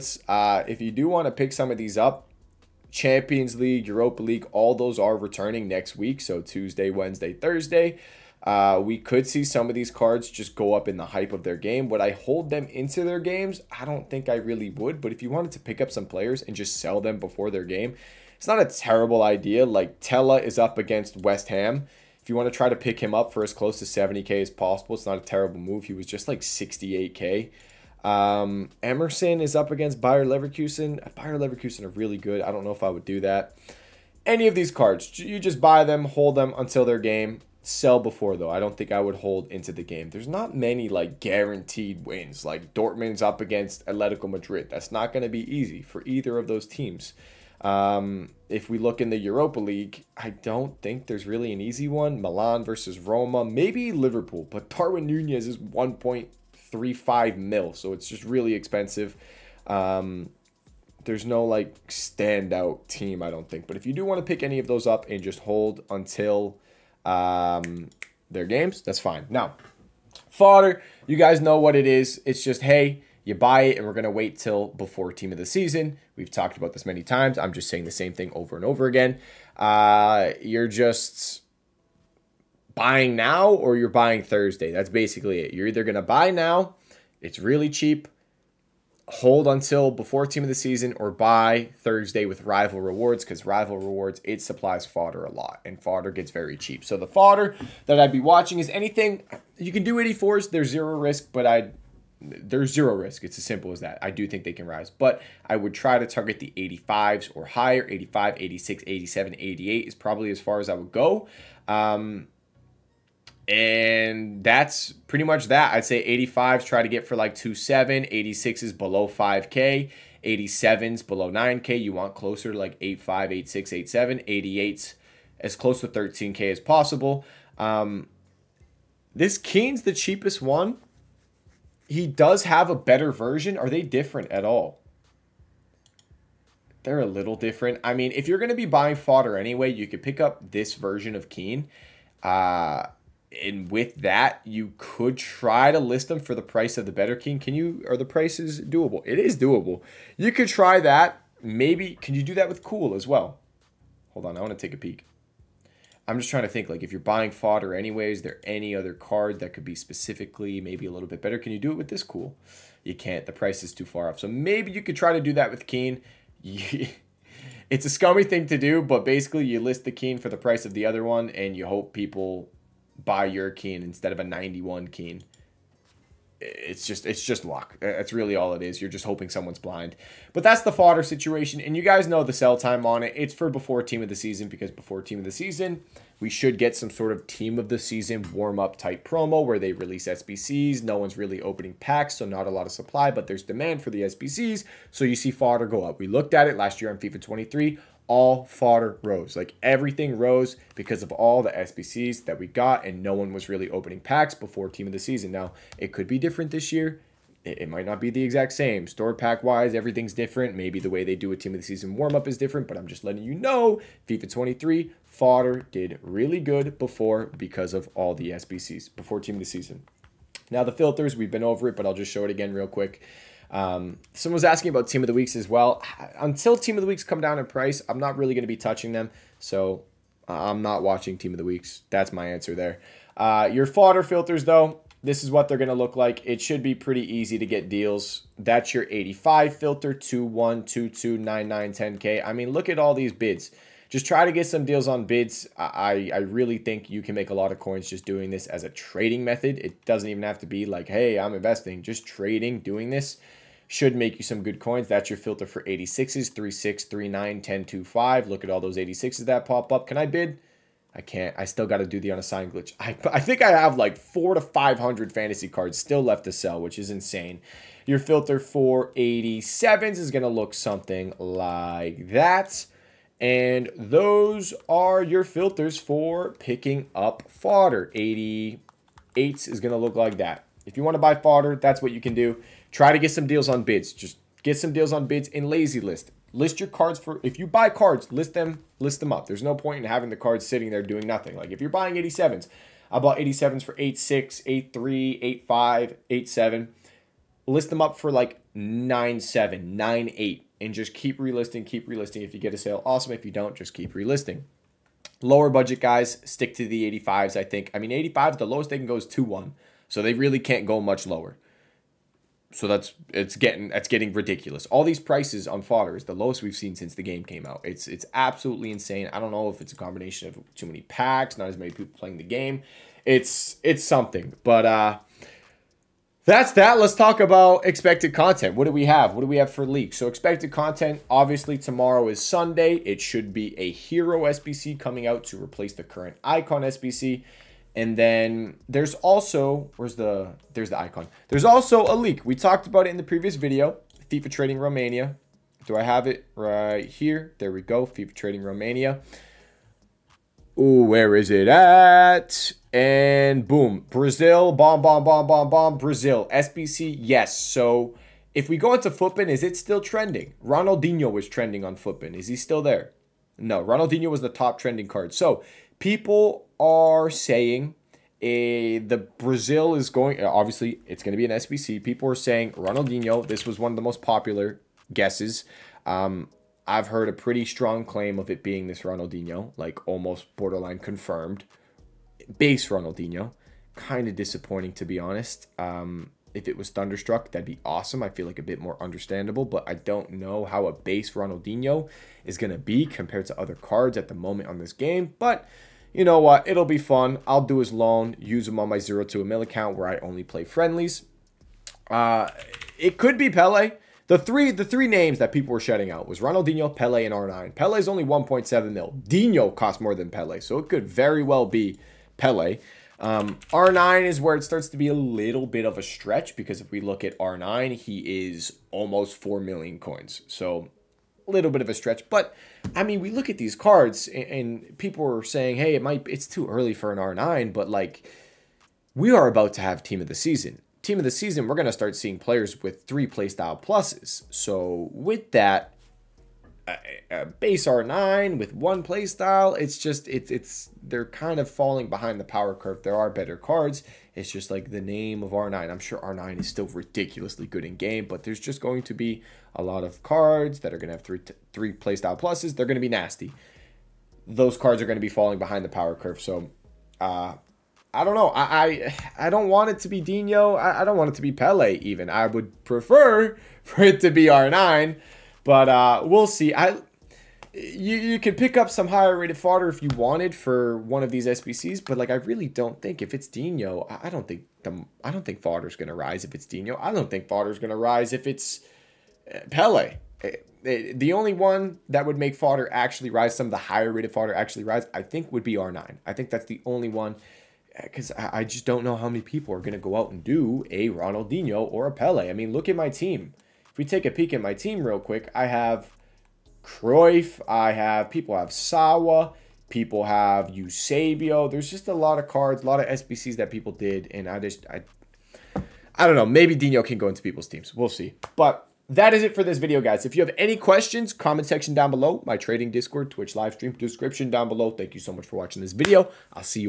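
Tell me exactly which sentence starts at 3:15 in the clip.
We looked at it last year on FIFA 23 all fodder rose.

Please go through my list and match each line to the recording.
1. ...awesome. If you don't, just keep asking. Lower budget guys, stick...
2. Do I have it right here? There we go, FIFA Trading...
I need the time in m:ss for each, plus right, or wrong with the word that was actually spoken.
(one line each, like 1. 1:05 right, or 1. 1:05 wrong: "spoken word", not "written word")
1. 5:02 wrong: "relisting", not "asking"
2. 5:45 right.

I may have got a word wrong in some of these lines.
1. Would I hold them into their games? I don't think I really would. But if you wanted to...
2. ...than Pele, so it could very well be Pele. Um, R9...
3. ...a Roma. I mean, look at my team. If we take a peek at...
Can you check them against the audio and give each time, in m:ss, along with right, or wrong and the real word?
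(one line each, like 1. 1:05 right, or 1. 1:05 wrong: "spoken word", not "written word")
1. 0:11 right
2. 6:49 right
3. 8:11 wrong: "Pele", not "Roma".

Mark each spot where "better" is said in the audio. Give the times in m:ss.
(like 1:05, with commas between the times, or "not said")
2:12, 2:26, 2:41, 7:23.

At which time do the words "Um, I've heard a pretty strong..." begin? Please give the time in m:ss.
6:15.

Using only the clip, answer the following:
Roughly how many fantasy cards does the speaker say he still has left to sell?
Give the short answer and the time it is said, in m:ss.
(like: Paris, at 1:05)
400 to 500, at 4:23.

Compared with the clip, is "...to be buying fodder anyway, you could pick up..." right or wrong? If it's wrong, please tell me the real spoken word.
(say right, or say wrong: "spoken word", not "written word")
right.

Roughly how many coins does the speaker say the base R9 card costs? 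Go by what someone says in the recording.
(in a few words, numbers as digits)
4 million.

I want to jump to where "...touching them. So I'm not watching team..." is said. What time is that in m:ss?
3:48.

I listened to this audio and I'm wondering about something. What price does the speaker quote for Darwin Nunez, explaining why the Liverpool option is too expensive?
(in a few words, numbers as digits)
1.35 mil.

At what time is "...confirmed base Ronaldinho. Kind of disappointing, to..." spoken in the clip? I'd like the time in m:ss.
6:20.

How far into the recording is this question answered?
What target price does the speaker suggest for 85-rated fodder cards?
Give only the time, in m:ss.
1:57.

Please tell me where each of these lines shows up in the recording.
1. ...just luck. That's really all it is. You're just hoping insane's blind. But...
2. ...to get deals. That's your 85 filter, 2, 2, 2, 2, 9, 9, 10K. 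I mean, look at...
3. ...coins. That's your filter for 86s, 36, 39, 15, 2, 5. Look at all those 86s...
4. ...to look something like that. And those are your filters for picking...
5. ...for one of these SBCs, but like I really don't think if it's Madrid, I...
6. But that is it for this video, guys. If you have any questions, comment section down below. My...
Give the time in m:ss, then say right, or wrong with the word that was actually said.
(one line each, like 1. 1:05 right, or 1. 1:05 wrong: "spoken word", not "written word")
1. 2:57 wrong: "someone", not "insane"
2. 3:57 wrong: "1", not "2"
3. 4:14 wrong: "10", not "15"
4. 4:30 right
5. 7:50 wrong: "Dino", not "Madrid"
6. 8:28 right.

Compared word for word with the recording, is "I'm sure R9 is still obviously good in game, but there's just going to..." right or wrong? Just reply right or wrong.
wrong.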